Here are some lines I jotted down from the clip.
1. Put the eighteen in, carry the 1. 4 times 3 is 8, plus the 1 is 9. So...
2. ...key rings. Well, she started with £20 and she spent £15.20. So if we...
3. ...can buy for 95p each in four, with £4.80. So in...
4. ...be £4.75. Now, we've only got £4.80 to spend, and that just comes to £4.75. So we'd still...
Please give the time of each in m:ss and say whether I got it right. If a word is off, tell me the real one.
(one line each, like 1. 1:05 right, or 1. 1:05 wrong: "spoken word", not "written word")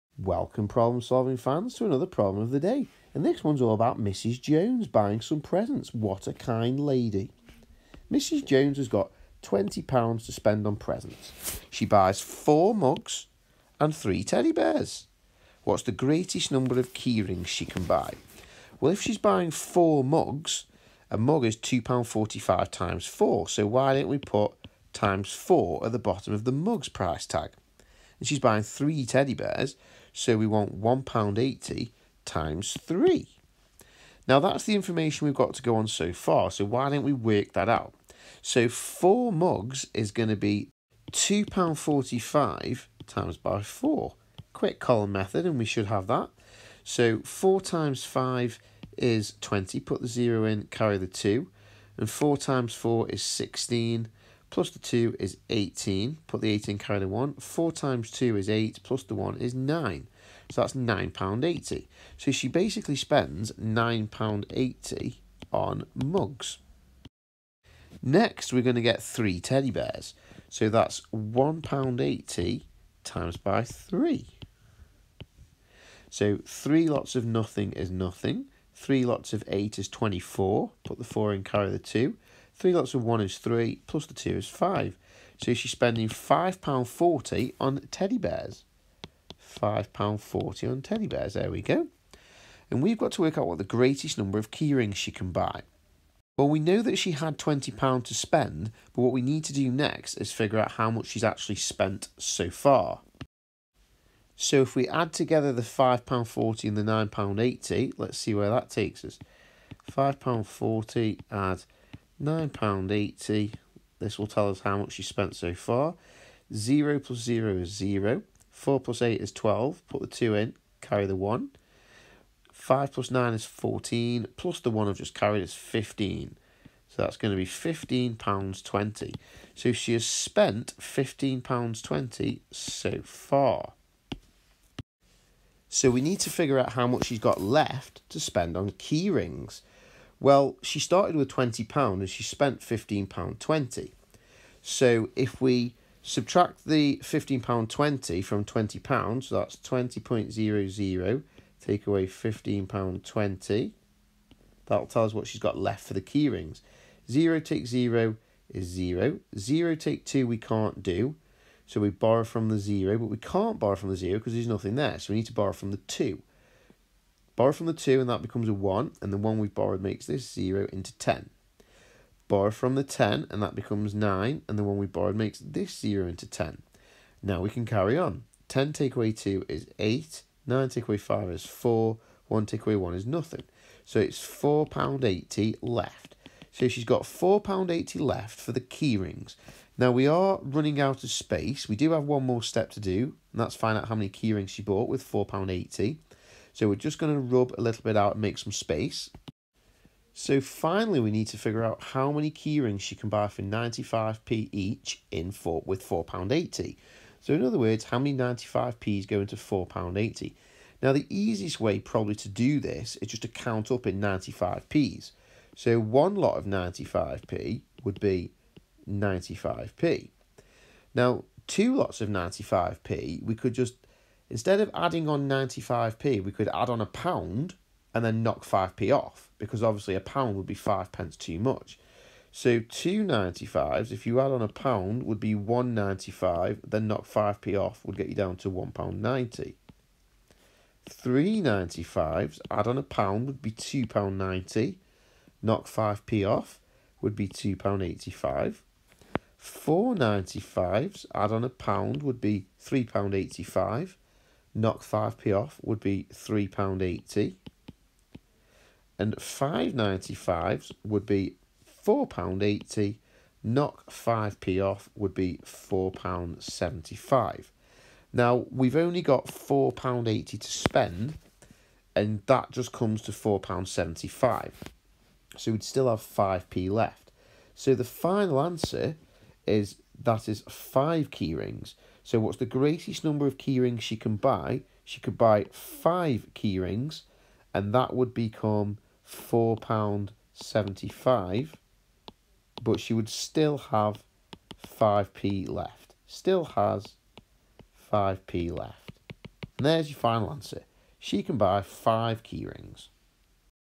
1. 0:56 wrong: "2", not "3"
2. 2:18 right
3. 3:22 right
4. 4:25 right.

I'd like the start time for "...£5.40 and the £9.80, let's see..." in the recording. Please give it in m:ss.
1:45.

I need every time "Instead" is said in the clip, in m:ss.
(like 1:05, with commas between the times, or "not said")
3:44.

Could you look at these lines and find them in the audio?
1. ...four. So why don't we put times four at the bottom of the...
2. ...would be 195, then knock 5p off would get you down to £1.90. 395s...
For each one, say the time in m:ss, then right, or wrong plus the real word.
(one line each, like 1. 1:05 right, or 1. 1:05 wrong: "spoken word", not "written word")
1. 0:23 right
2. 3:55 right.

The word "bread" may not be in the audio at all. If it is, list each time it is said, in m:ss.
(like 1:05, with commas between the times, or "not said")
not said.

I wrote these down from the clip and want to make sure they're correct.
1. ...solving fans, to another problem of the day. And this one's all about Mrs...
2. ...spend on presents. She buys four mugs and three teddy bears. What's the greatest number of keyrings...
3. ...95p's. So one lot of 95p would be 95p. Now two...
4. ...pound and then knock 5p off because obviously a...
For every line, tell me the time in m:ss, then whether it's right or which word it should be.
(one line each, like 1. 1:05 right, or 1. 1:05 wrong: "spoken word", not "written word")
1. 0:01 right
2. 0:10 right
3. 3:34 right
4. 3:46 right.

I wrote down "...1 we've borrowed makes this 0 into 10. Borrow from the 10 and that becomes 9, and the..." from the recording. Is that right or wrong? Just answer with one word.
right.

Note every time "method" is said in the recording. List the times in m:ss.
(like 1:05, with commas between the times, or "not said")
0:45.